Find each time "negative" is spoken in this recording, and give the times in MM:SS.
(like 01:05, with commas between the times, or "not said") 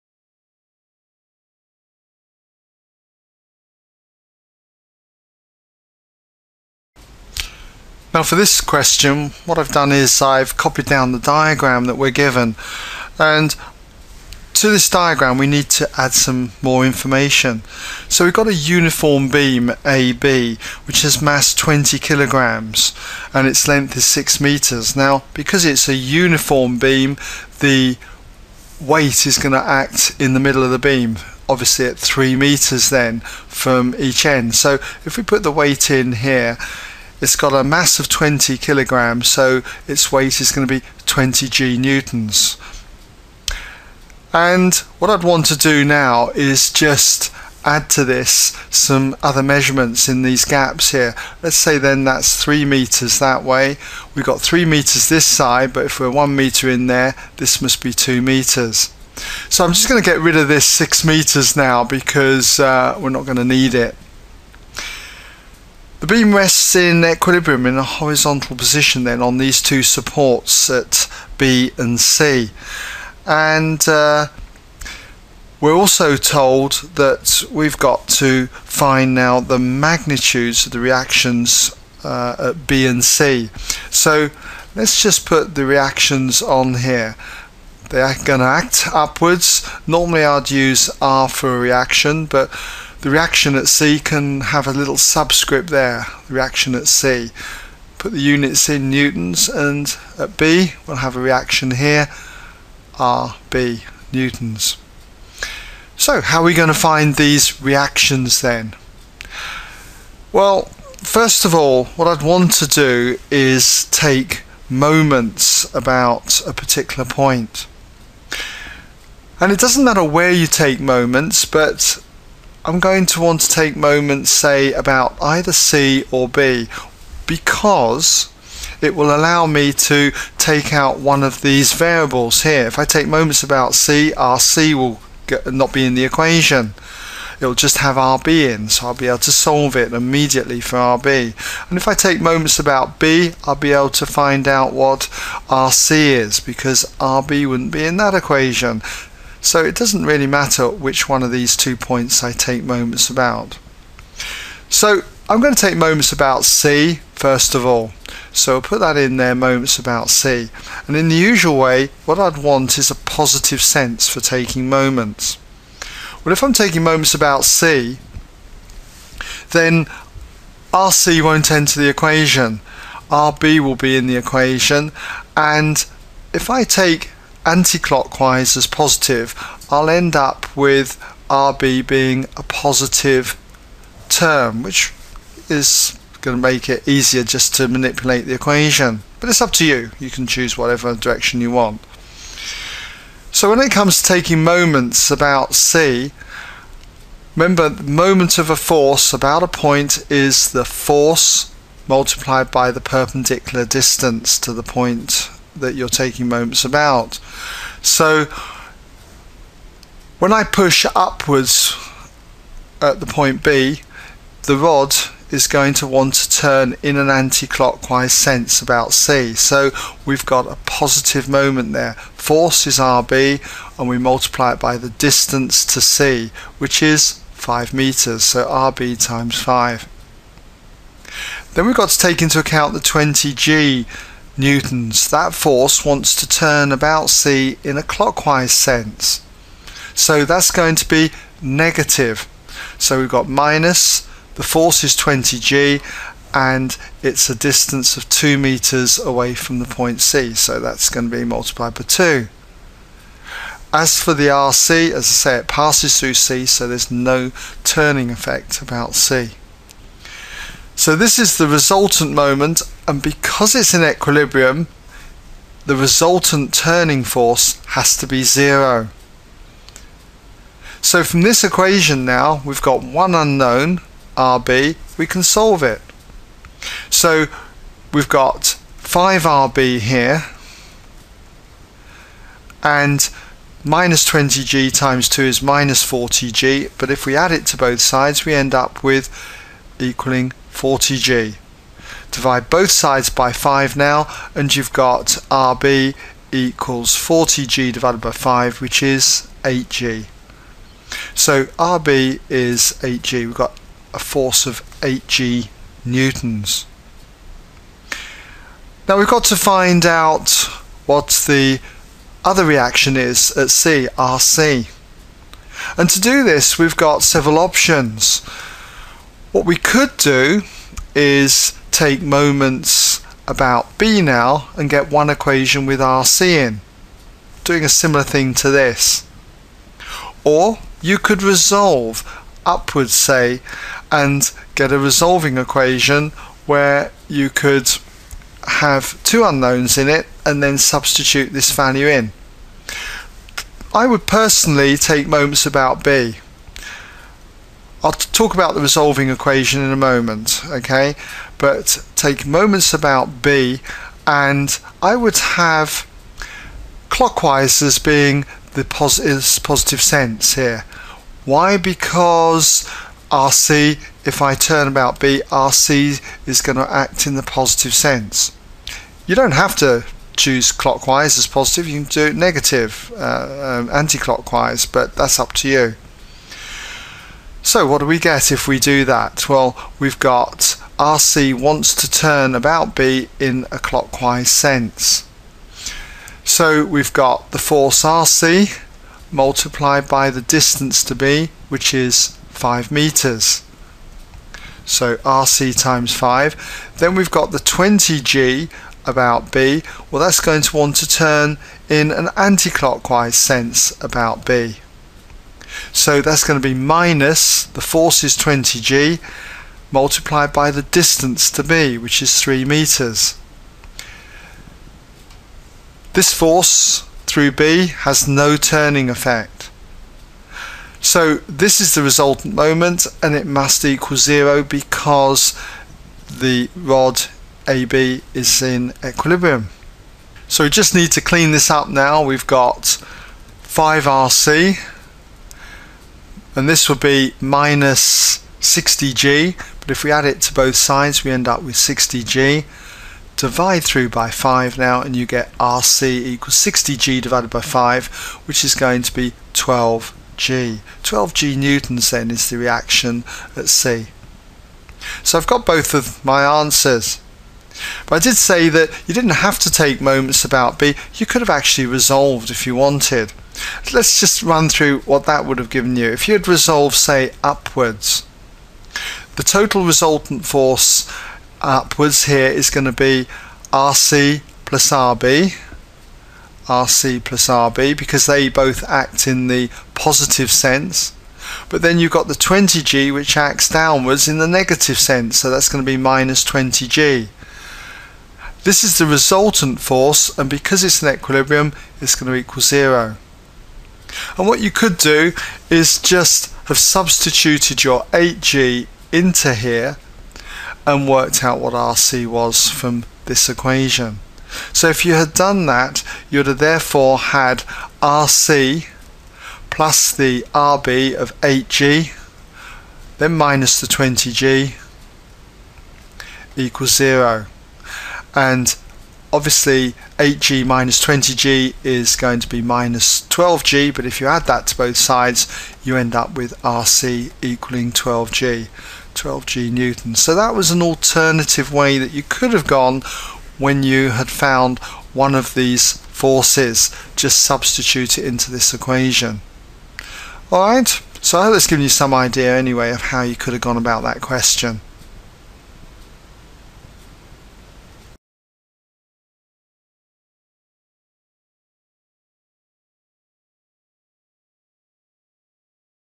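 04:01, 06:12, 08:04.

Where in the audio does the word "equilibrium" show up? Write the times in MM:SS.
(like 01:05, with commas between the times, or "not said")
01:07, 04:23, 07:08, 08:10.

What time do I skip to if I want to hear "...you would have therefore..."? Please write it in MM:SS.
08:26.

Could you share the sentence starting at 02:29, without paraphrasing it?
So it doesn't really matter which one of these two points I take moments about.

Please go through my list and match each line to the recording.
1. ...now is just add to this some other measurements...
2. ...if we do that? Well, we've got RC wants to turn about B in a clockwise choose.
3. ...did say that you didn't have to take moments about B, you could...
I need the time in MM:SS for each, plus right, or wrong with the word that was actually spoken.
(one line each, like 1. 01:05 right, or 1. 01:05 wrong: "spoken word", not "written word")
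1. 00:45 right
2. 06:18 wrong: "sense", not "choose"
3. 07:37 right.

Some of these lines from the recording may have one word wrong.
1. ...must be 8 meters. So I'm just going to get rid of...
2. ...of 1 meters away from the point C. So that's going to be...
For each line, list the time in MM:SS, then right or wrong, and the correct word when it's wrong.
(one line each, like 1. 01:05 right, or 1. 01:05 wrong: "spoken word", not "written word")
1. 00:57 wrong: "2", not "8"
2. 04:07 wrong: "2", not "1".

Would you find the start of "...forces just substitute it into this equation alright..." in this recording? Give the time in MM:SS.
08:55.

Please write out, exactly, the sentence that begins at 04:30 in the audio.
So from this equation now, we've got one unknown, RB, we can solve it.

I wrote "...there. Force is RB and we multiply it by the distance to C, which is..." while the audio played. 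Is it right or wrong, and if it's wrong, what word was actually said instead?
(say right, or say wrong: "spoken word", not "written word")
right.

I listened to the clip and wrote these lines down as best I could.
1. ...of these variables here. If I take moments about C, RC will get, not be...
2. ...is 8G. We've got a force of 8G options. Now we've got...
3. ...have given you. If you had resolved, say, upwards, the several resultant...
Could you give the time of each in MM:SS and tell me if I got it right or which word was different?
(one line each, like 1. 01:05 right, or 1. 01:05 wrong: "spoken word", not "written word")
1. 02:11 right
2. 05:02 wrong: "newtons", not "options"
3. 07:45 wrong: "total", not "several".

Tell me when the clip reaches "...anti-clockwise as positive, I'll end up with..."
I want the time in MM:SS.
02:57.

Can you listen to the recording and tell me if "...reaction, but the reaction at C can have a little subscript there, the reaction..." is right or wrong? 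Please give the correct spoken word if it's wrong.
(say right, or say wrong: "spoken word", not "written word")
right.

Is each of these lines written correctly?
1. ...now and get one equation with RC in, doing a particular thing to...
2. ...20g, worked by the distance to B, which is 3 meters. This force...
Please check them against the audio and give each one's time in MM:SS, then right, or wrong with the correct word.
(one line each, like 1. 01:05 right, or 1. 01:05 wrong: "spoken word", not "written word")
1. 05:24 wrong: "similar", not "particular"
2. 06:48 wrong: "multiplied", not "worked".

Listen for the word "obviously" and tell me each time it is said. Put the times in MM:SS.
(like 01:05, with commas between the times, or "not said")
00:31, 08:39.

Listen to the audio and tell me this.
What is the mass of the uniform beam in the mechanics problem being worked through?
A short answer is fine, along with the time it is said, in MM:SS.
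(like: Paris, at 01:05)
20 kilograms, at 00:21.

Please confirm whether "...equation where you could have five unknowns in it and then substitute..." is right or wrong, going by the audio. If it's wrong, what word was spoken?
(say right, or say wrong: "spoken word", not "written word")
wrong: "two", not "five".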